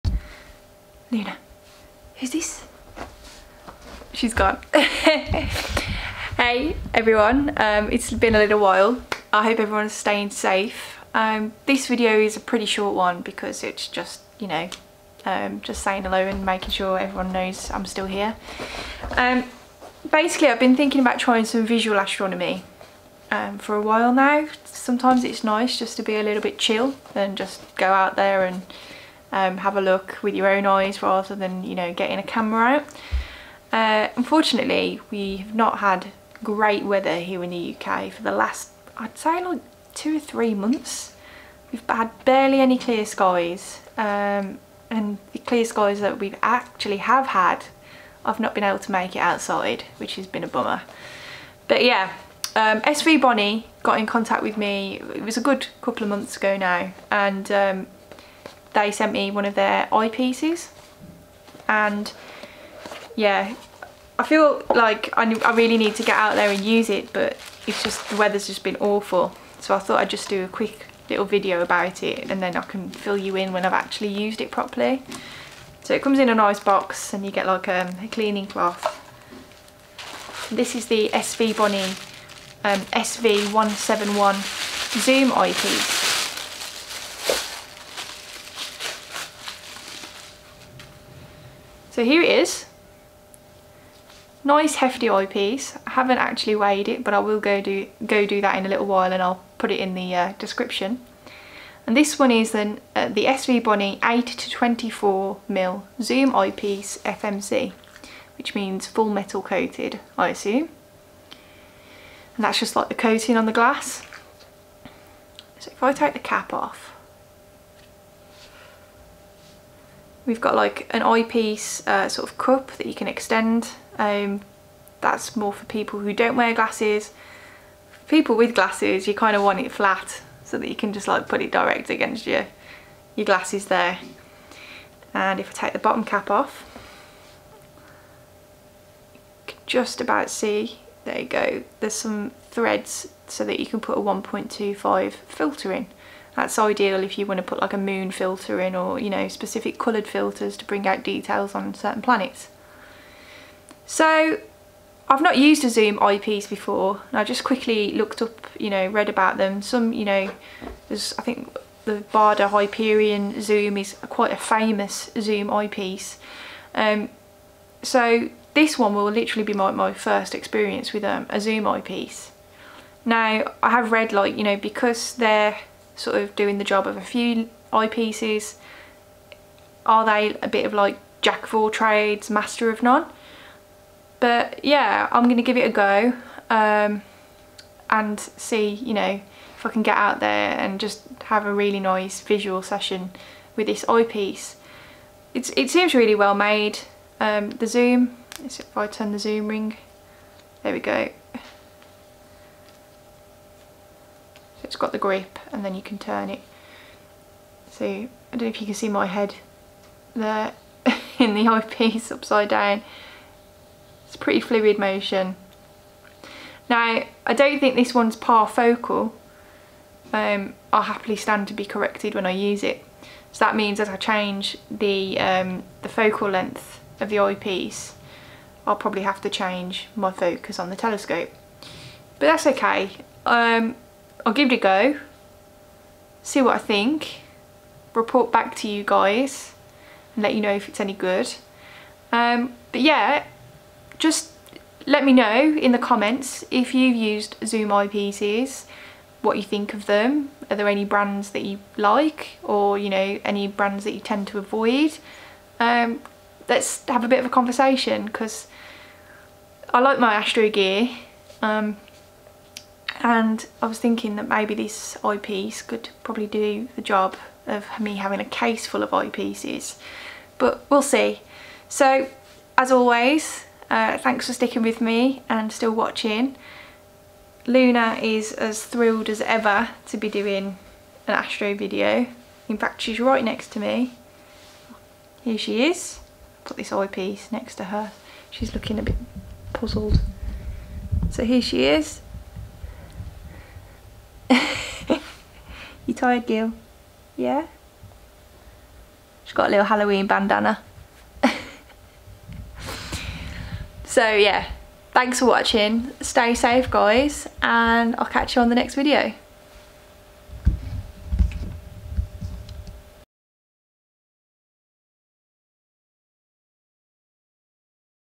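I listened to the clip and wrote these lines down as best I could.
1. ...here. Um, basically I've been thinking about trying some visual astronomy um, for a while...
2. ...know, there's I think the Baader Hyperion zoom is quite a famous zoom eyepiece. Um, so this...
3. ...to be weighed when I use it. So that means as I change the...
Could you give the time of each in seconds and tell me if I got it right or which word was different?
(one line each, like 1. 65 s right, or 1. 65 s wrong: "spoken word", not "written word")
1. 18 s right
2. 160 s right
3. 221 s wrong: "corrected", not "weighed".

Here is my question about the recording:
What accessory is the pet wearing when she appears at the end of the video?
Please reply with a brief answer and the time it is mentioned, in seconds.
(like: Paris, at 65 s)
Halloween bandana, at 299 s.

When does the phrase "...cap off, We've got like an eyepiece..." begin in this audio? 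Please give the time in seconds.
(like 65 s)
116 s.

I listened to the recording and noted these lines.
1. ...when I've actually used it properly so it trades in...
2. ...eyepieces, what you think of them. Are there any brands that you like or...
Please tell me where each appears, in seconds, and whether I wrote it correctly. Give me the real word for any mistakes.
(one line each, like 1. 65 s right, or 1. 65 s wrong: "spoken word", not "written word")
1. 73 s wrong: "comes", not "trades"
2. 247 s right.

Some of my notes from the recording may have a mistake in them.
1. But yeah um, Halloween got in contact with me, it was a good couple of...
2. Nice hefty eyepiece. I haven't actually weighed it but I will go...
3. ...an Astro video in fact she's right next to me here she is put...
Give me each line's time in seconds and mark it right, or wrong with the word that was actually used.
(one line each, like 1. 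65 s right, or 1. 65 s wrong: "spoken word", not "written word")
1. 51 s wrong: "Svbony", not "Halloween"
2. 94 s right
3. 281 s right.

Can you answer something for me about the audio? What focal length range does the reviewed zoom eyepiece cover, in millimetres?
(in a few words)
8 to 24 mm.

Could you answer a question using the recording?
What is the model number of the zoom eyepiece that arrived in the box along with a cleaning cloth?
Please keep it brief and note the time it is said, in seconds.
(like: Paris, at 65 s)
SV171, at 82 s.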